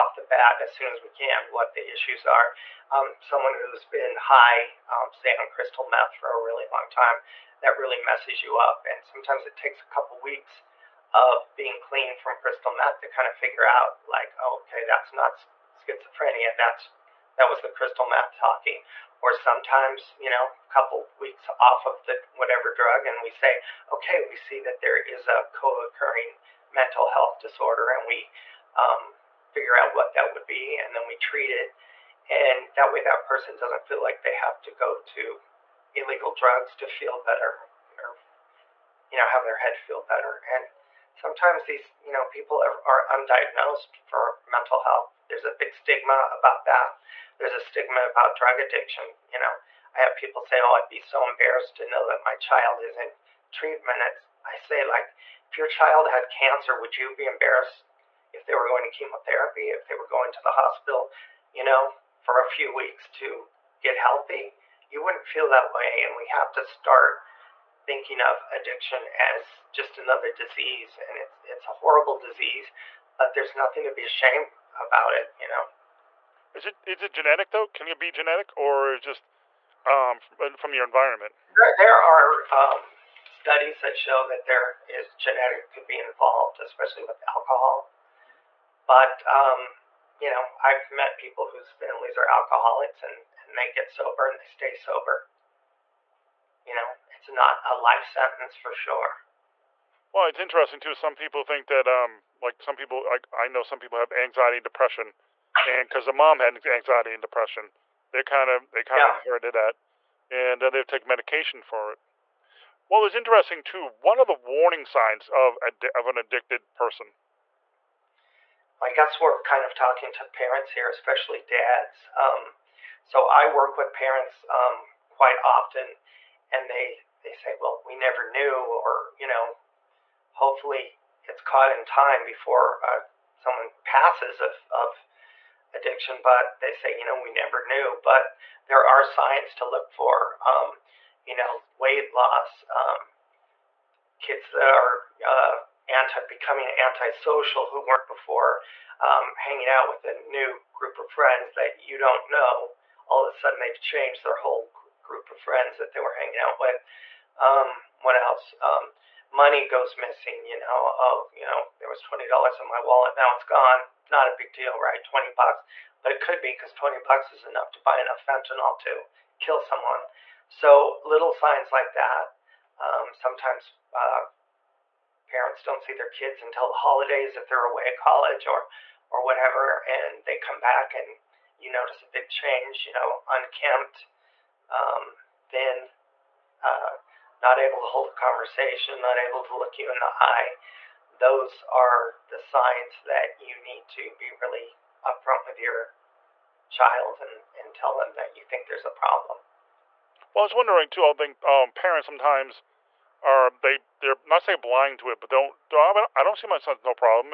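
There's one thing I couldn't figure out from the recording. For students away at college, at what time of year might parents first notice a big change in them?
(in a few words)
the holidays.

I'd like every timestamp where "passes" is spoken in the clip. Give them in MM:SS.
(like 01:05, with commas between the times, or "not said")
02:13.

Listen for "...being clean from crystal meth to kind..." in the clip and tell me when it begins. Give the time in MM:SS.
00:11.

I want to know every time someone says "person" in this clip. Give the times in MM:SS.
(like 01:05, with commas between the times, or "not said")
00:33, 01:56.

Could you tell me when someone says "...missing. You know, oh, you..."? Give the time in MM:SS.
02:39.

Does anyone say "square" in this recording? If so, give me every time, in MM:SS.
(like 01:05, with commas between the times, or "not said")
not said.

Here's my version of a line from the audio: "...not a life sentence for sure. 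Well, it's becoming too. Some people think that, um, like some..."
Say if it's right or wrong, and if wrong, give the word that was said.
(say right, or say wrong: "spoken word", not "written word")
wrong: "interesting", not "becoming".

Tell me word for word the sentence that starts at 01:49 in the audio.
of inherited that, and then uh, they've taken medication for it.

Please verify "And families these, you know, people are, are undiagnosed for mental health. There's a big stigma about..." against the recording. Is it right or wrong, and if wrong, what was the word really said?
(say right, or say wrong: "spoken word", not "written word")
wrong: "sometimes", not "families".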